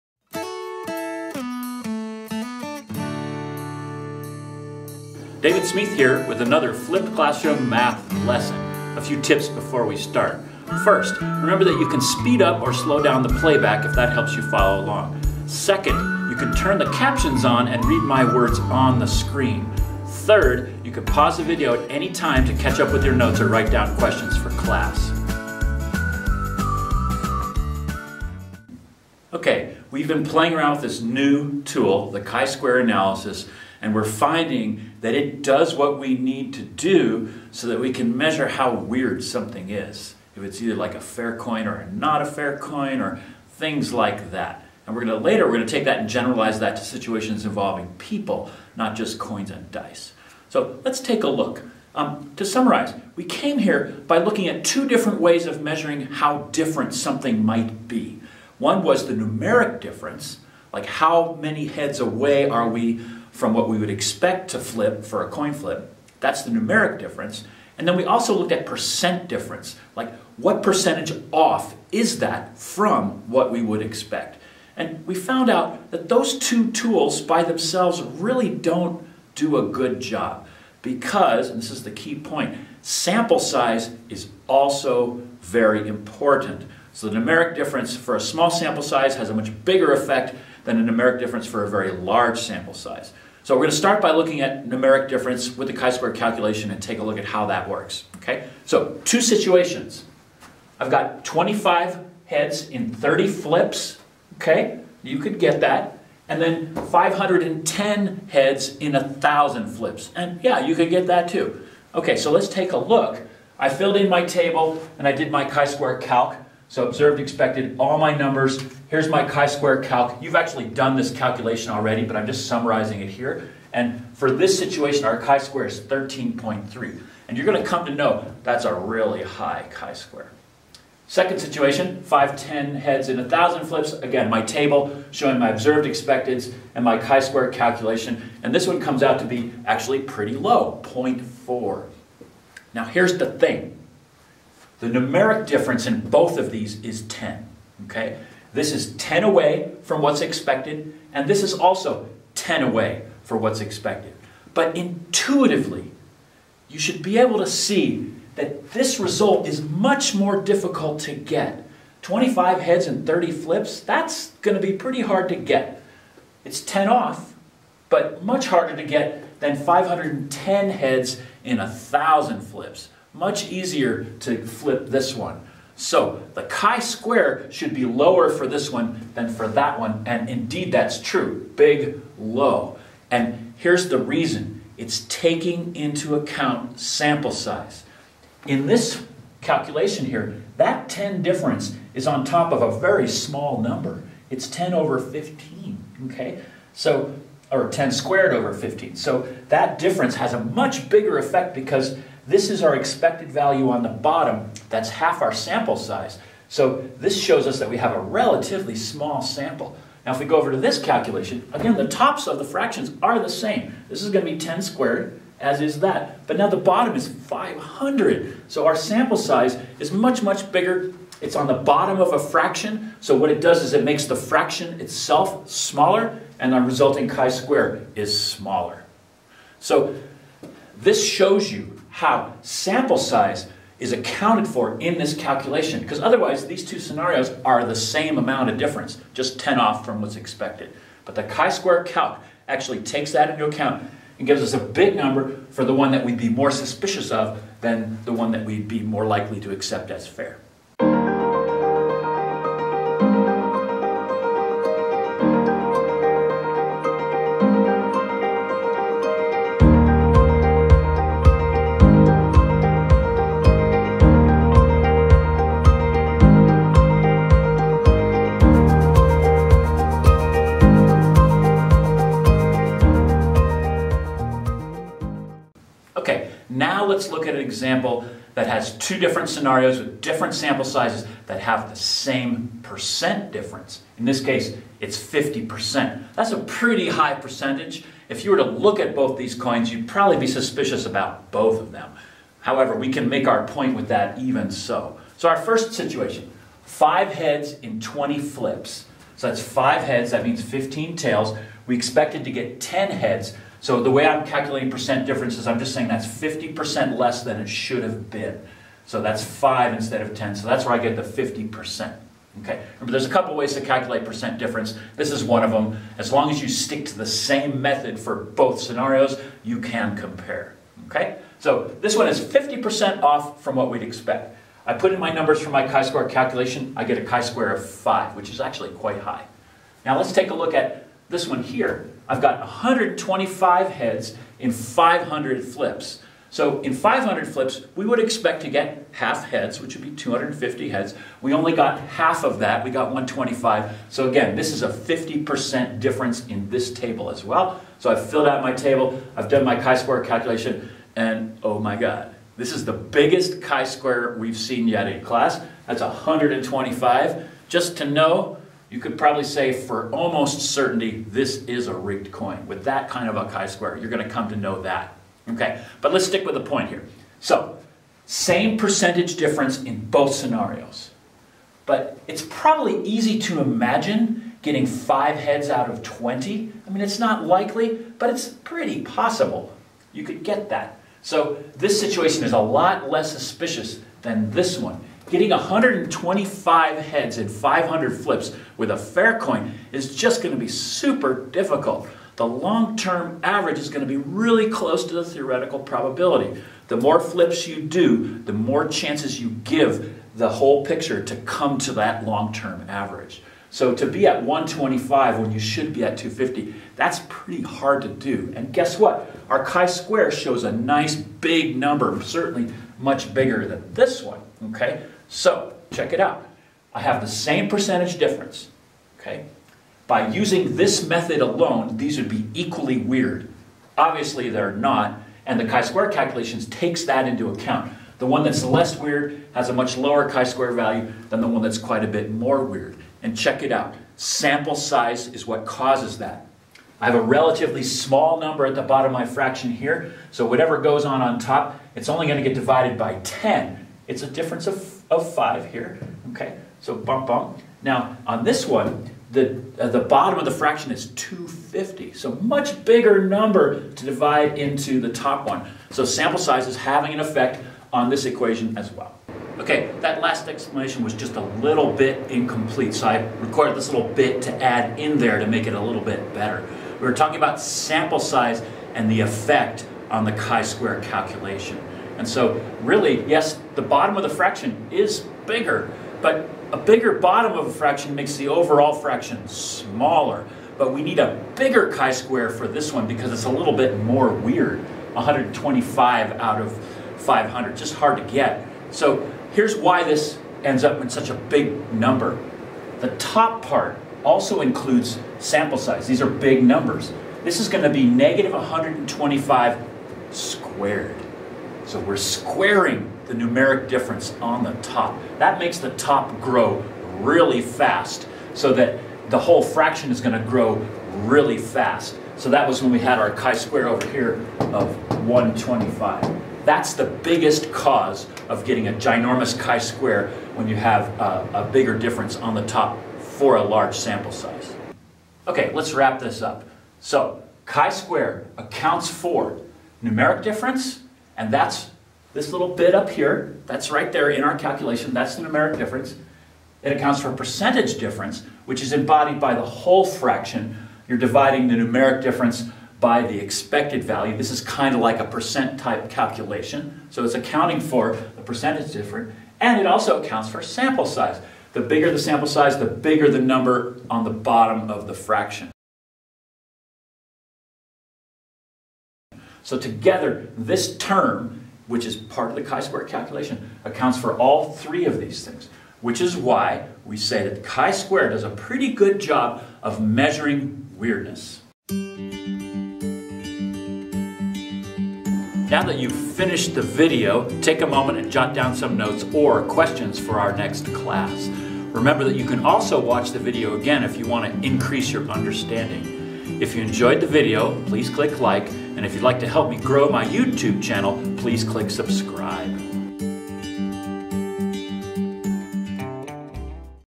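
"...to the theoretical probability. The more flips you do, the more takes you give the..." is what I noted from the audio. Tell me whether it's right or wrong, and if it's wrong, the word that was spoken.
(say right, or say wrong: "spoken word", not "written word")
wrong: "chances", not "takes".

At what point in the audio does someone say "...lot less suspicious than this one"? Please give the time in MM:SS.
06:22.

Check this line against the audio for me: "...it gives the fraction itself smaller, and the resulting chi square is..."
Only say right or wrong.
wrong.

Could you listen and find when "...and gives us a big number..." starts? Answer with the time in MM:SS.
04:04.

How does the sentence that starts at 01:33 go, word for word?
So we're going to start by looking at numeric difference with the chi-square calculation and take a look at how that works.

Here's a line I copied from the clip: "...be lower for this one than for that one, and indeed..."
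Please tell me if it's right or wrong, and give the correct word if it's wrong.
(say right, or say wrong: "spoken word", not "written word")
right.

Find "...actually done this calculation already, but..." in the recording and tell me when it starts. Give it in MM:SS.
02:00.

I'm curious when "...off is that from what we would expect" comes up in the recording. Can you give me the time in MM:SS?
01:11.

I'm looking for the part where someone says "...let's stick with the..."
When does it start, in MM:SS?
06:05.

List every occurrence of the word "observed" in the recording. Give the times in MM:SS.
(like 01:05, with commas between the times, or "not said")
01:56, 02:15.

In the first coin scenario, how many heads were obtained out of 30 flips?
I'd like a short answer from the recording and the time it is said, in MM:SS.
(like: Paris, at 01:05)
25, at 01:41.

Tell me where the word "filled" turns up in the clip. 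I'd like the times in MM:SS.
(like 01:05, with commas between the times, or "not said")
01:53, 05:48.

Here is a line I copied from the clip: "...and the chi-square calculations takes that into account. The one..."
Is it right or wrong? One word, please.
right.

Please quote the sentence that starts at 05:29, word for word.
Now let's take a look at this one here.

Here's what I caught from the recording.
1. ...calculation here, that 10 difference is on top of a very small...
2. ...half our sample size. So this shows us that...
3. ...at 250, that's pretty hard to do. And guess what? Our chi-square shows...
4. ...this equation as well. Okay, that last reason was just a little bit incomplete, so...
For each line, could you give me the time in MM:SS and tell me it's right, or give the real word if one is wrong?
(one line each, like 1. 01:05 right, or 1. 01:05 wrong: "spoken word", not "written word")
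1. 03:09 right
2. 03:24 right
3. 06:45 right
4. 07:37 wrong: "explanation", not "reason".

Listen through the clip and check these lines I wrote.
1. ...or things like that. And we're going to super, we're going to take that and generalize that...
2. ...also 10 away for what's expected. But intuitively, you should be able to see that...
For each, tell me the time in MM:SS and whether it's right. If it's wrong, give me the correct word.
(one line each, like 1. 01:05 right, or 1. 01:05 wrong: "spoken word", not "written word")
1. 00:43 wrong: "later", not "super"
2. 02:31 right.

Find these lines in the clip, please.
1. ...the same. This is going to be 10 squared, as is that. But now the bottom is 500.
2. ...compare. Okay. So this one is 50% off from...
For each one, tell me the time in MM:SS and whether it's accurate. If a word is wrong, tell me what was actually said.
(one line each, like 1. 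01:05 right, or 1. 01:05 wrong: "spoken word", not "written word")
1. 03:33 right
2. 05:19 right.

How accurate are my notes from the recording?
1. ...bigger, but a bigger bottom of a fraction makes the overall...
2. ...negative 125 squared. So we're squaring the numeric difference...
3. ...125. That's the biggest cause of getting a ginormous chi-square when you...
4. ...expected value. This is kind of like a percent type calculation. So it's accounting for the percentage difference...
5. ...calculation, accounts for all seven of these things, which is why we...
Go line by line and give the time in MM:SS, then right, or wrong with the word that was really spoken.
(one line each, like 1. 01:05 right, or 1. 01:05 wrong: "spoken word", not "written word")
1. 07:55 right
2. 08:17 right
3. 08:35 right
4. 09:03 right
5. 09:22 wrong: "three", not "seven".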